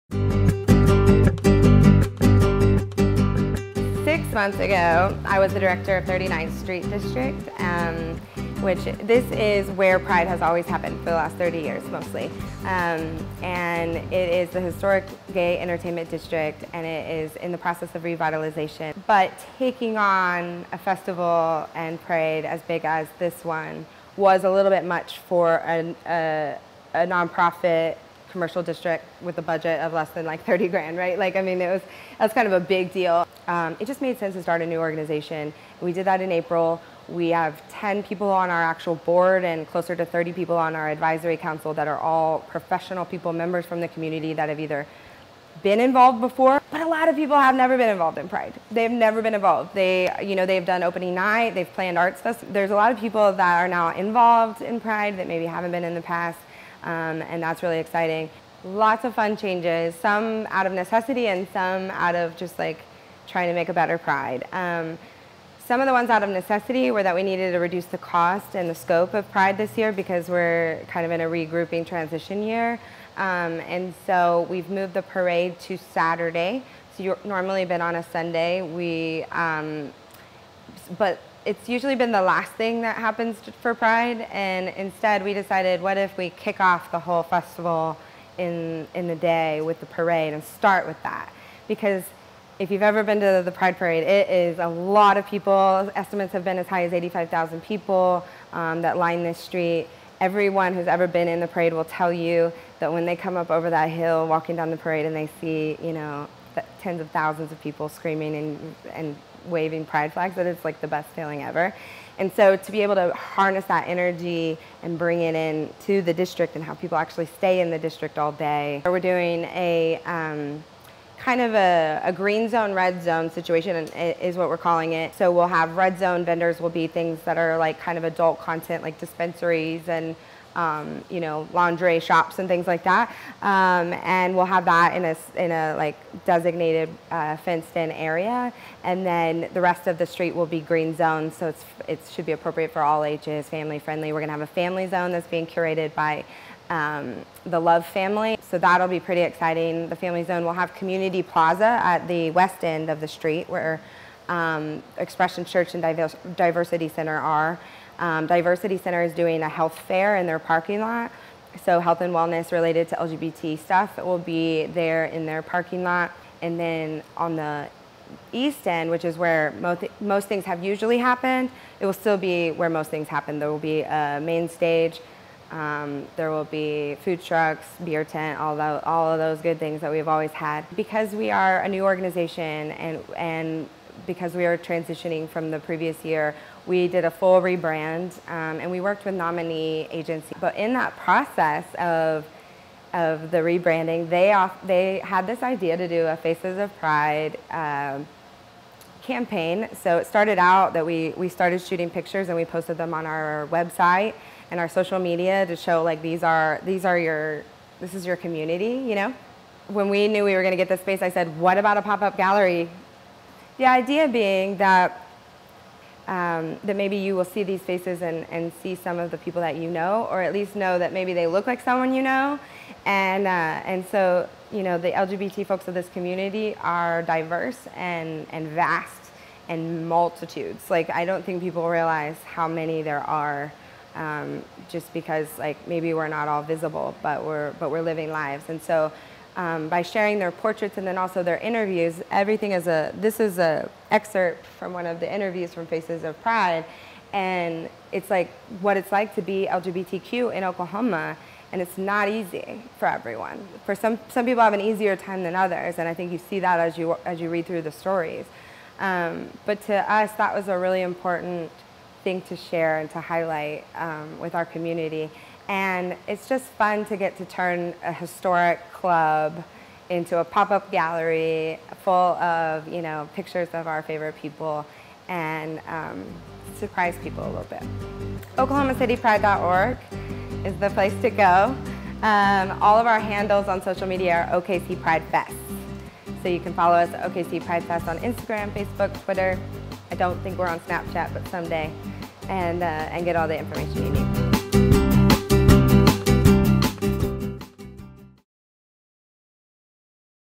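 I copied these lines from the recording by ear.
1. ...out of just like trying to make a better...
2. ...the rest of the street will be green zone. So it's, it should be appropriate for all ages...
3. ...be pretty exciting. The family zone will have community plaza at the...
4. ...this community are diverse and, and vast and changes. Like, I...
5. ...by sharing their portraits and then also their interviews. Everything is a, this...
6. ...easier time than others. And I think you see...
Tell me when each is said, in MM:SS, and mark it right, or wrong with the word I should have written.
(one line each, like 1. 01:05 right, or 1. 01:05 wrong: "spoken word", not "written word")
1. 01:01 right
2. 02:19 right
3. 02:28 right
4. 03:45 wrong: "multitudes", not "changes"
5. 03:59 right
6. 04:14 right.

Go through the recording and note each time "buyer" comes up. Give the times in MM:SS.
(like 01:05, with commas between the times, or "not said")
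not said.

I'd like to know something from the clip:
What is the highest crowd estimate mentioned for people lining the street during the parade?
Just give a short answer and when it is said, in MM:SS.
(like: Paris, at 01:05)
85,000, at 01:36.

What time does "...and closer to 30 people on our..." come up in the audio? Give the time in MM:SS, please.
00:39.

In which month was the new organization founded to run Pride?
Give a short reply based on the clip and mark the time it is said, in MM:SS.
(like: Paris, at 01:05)
April, at 00:36.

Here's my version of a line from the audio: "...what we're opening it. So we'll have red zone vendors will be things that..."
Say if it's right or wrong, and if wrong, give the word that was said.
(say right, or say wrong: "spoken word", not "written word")
wrong: "calling", not "opening".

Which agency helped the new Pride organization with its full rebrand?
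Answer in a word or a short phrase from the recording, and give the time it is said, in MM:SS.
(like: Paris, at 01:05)
Nominee agency, at 03:09.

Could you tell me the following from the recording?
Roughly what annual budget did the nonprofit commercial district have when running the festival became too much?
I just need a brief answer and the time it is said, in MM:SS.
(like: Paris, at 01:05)
less than $30,000, at 00:29.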